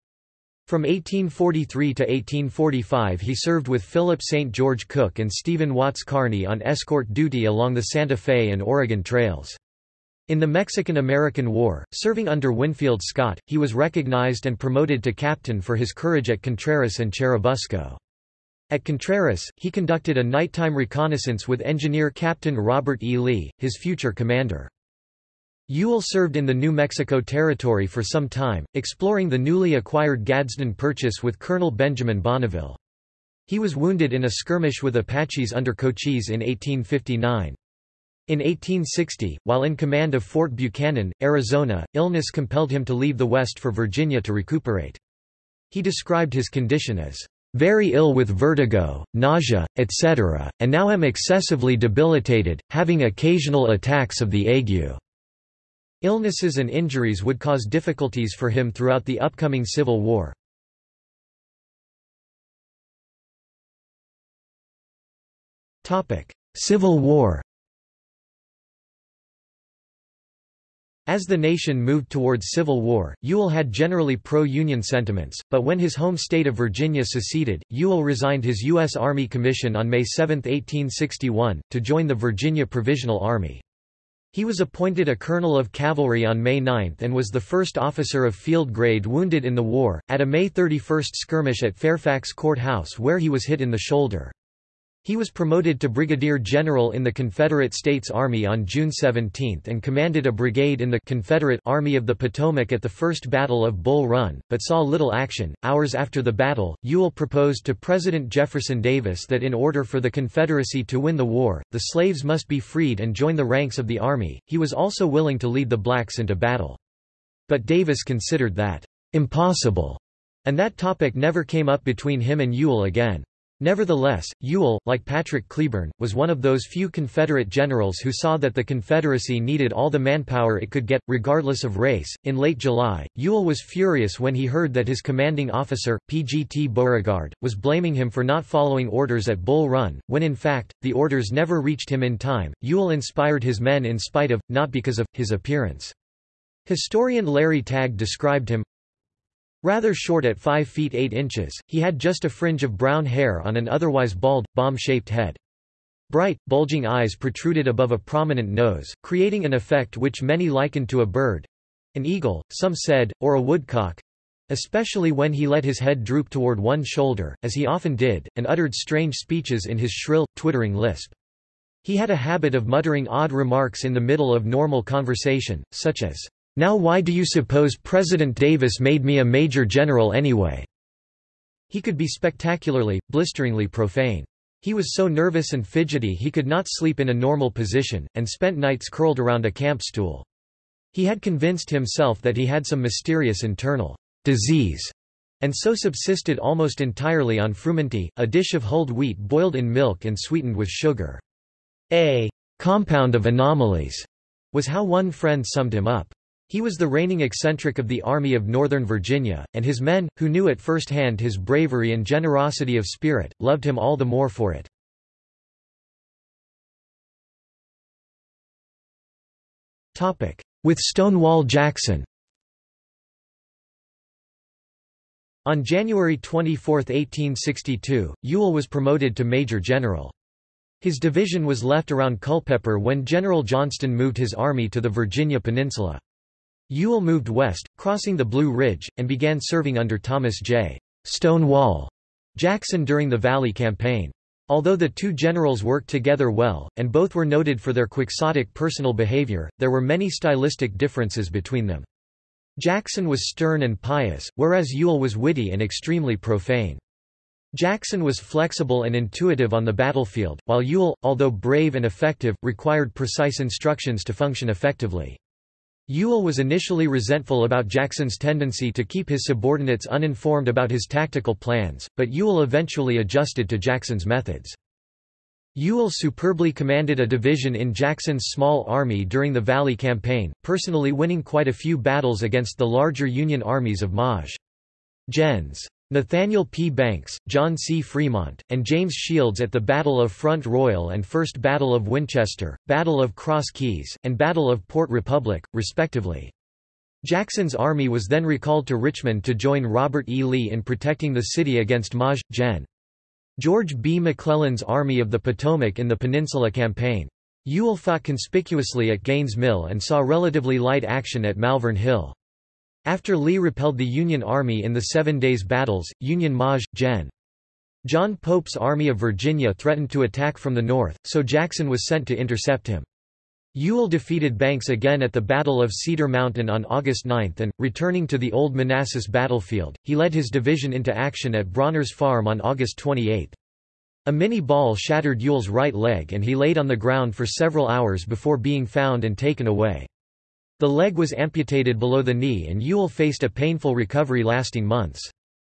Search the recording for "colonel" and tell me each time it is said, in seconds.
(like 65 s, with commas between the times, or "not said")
31 s, 85 s.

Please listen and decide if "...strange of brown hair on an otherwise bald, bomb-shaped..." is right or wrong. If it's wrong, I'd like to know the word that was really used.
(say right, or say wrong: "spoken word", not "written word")
wrong: "fringe", not "strange".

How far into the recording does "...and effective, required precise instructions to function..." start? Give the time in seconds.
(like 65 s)
261 s.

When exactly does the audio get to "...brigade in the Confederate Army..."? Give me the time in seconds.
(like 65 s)
100 s.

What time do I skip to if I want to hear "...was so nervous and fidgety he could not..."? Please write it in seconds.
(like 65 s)
184 s.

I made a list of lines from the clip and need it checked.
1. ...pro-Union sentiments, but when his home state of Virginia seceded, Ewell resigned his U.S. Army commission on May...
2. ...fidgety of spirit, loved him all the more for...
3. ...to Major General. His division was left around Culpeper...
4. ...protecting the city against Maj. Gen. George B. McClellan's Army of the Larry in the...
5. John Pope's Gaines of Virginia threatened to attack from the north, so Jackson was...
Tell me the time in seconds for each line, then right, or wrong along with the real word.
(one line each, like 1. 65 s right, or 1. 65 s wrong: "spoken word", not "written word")
1. 74 s right
2. 212 s wrong: "generosity", not "fidgety"
3. 229 s right
4. 300 s wrong: "Potomac", not "Larry"
5. 317 s wrong: "Army", not "Gaines".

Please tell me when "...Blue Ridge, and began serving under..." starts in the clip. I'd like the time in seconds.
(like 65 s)
238 s.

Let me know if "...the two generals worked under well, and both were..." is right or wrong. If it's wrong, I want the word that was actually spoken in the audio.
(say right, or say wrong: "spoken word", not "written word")
wrong: "together", not "under".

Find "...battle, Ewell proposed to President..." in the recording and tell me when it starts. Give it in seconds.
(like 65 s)
106 s.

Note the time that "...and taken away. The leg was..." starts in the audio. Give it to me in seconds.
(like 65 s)
339 s.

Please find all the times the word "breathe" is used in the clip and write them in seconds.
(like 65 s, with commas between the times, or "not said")
not said.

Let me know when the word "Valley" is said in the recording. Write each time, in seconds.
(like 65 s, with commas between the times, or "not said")
243 s, 279 s.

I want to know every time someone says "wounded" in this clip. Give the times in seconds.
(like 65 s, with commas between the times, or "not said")
33 s, 89 s.